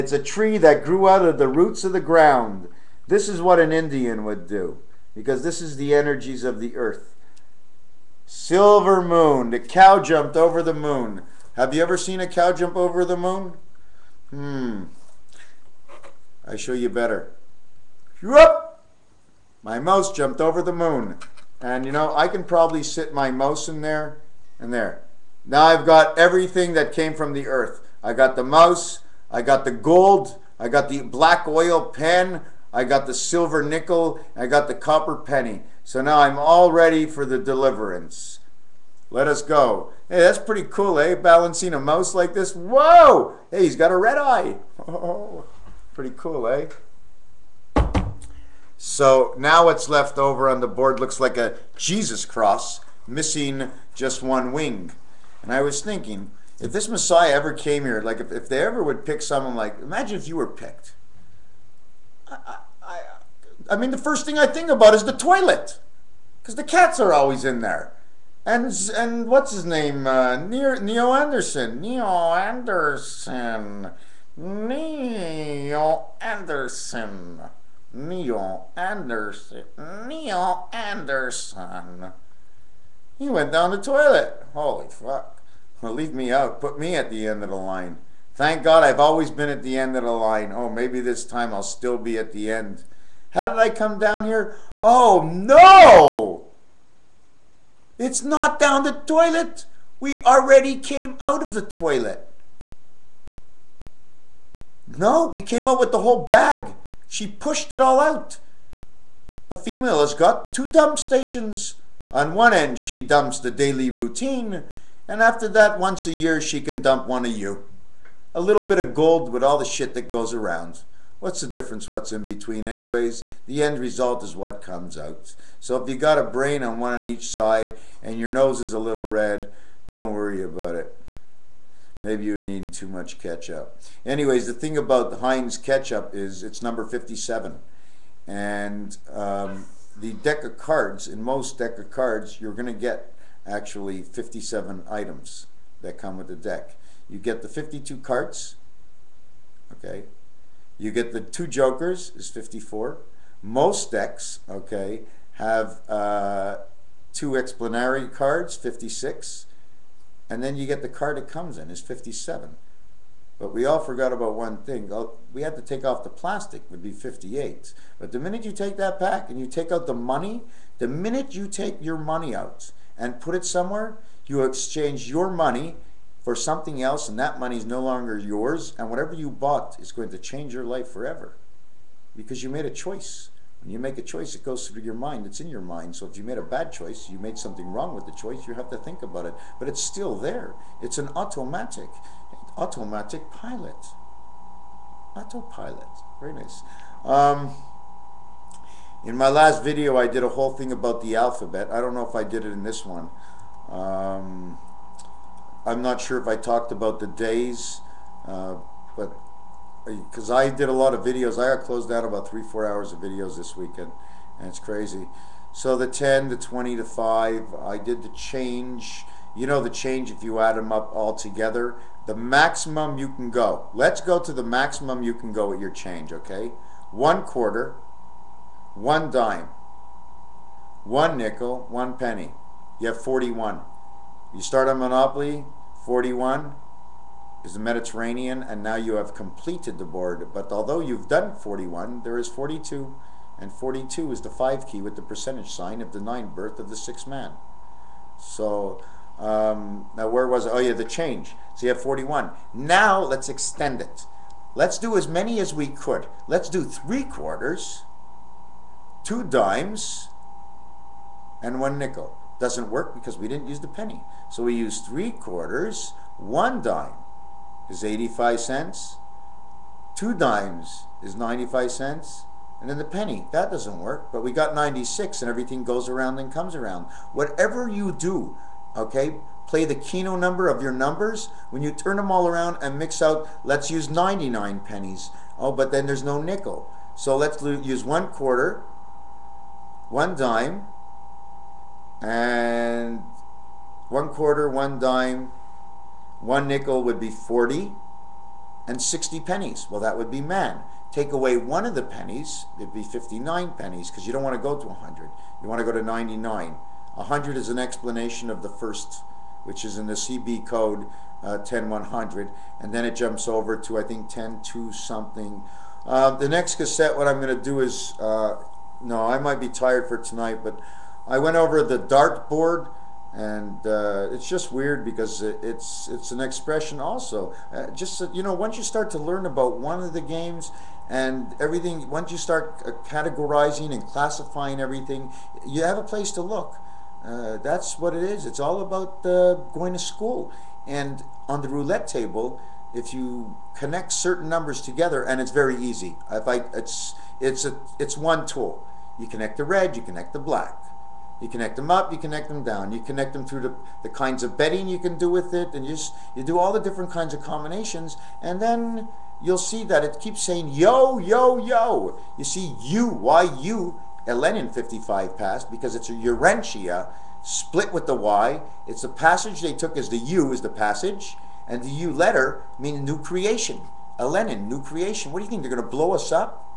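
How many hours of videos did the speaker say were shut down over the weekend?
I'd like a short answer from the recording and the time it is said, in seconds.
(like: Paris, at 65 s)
3 or 4 hours, at 212 s.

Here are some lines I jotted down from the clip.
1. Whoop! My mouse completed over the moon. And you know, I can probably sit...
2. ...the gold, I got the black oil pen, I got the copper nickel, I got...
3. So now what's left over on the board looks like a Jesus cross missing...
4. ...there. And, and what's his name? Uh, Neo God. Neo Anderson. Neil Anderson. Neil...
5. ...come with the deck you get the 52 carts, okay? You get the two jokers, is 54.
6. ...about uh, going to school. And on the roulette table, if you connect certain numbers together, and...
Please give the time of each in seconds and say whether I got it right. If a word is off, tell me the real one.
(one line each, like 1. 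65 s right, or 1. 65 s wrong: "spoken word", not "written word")
1. 18 s wrong: "jumped", not "completed"
2. 29 s wrong: "silver", not "copper"
3. 48 s right
4. 67 s wrong: "Anderson", not "God"
5. 145 s right
6. 338 s right.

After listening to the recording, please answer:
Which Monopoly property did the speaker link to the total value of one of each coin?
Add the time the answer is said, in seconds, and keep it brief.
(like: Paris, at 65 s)
Mediterranean, at 237 s.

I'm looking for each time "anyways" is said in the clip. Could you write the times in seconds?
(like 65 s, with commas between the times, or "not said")
122 s, 134 s.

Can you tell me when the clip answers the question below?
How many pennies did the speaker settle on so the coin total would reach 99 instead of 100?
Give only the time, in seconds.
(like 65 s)
302 s.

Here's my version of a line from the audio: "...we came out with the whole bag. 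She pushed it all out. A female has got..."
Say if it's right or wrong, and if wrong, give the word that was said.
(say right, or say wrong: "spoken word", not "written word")
right.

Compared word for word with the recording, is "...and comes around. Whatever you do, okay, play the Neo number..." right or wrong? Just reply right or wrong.
wrong.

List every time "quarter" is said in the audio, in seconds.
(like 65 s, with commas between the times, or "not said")
227 s, 257 s, 265 s, 288 s, 294 s.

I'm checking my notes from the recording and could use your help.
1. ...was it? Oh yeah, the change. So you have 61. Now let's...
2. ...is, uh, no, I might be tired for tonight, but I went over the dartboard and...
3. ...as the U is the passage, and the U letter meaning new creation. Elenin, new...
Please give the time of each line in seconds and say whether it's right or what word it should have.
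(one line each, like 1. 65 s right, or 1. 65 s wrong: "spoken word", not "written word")
1. 250 s wrong: "41", not "61"
2. 317 s right
3. 369 s right.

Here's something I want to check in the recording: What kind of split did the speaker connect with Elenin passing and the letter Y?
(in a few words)
Urantia split.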